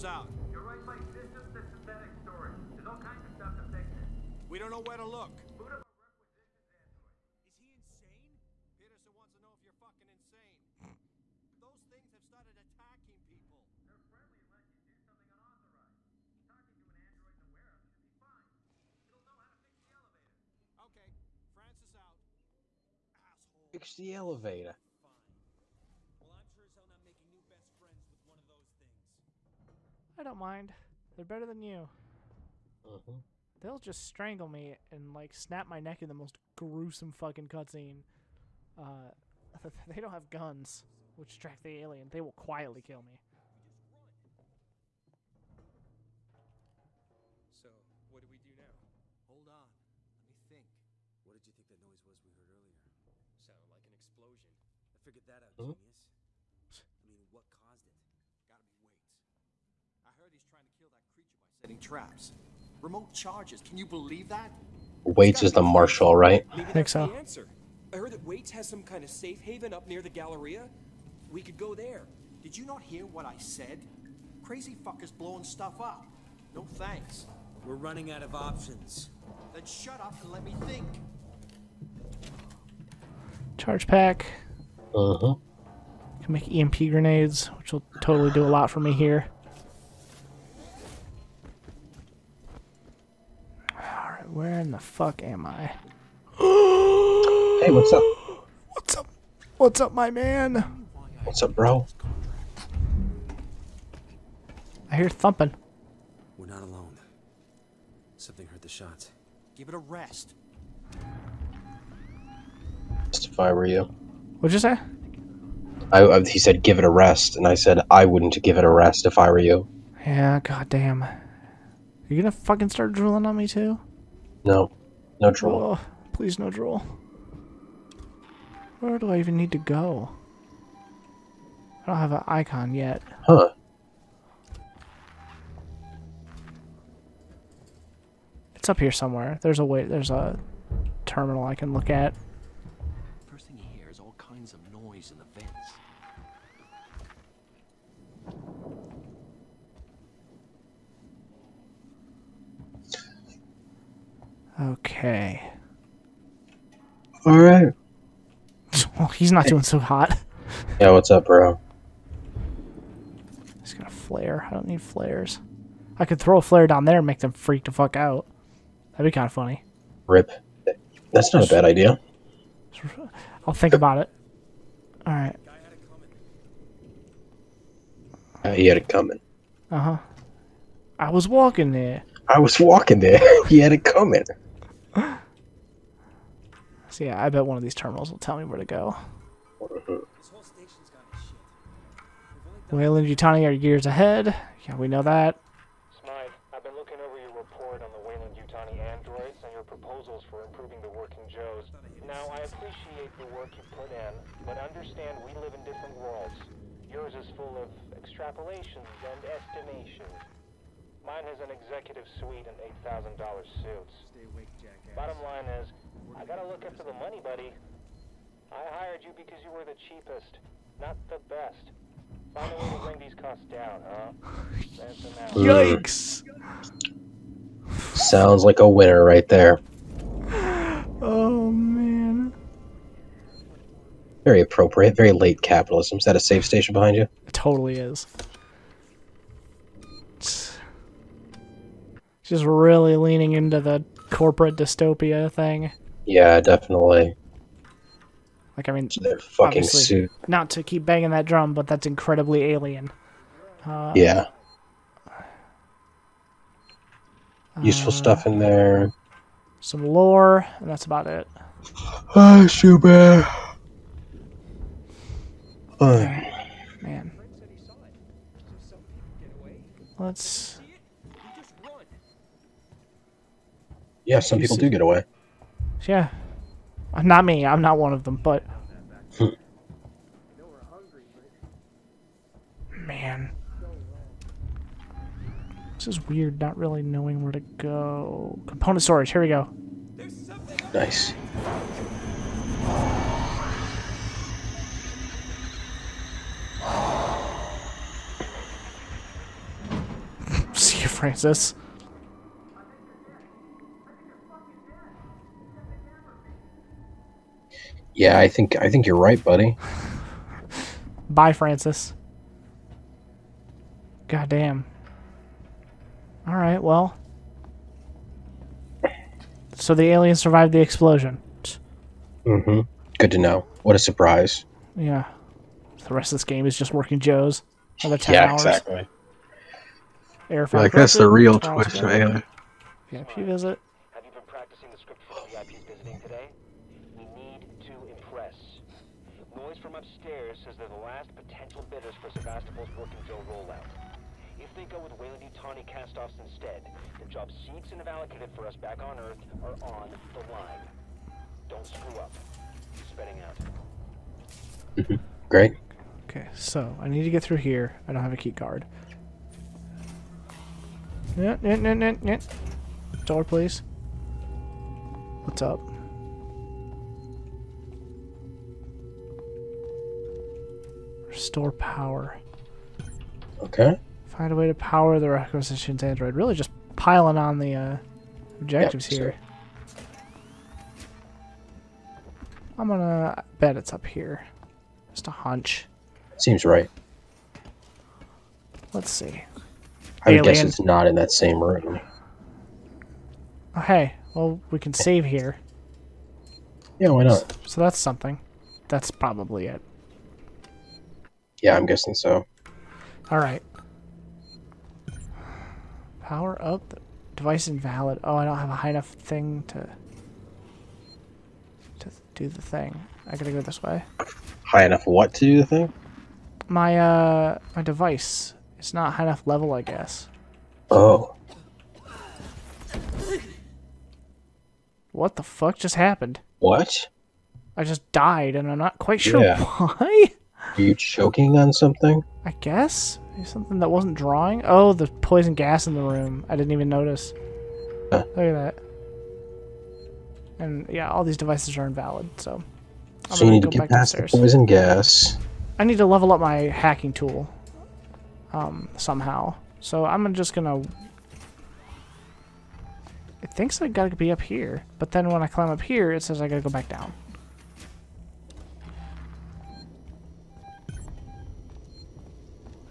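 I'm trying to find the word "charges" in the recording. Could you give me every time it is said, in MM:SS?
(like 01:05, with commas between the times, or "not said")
01:03, 01:23.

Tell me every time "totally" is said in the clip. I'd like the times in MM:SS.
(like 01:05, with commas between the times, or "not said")
01:27, 03:57.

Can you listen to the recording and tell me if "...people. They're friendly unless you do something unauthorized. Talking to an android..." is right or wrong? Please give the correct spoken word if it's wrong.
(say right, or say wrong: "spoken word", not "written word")
right.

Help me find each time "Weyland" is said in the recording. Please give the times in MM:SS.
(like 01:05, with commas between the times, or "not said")
03:12, 03:18, 05:44.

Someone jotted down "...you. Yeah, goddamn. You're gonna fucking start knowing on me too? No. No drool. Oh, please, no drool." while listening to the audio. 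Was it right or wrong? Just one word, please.
wrong.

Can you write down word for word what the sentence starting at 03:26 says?
Yours is full of extrapolations and estimations.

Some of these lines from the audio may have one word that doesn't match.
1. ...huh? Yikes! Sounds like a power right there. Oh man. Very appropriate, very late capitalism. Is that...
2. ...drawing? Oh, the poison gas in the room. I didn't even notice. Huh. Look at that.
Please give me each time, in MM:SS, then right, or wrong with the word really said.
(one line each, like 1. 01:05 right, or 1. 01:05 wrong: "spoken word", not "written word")
1. 03:43 wrong: "winner", not "power"
2. 07:13 right.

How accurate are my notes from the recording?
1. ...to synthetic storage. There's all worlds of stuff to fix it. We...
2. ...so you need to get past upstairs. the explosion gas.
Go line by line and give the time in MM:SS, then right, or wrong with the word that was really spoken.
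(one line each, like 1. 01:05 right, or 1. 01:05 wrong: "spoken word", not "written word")
1. 00:01 wrong: "kinds", not "worlds"
2. 07:23 wrong: "poison", not "explosion".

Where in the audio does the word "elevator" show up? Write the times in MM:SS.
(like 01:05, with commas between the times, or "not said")
00:19, 00:24.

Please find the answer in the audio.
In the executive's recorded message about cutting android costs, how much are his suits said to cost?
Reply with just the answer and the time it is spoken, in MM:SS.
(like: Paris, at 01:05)
$8,000, at 03:32.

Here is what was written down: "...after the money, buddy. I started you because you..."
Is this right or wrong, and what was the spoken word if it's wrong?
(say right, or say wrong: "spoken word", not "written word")
wrong: "hired", not "started".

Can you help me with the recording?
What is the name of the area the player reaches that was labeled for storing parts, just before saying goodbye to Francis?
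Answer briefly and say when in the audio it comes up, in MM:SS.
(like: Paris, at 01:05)
Component storage, at 04:48.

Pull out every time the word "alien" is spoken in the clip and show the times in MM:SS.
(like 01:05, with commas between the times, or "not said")
00:41, 04:12, 05:19, 05:31.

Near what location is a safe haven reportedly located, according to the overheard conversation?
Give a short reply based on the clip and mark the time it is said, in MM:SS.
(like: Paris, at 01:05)
The Galleria, at 01:10.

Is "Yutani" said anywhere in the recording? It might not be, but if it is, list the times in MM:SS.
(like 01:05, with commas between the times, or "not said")
03:12, 03:18, 05:44.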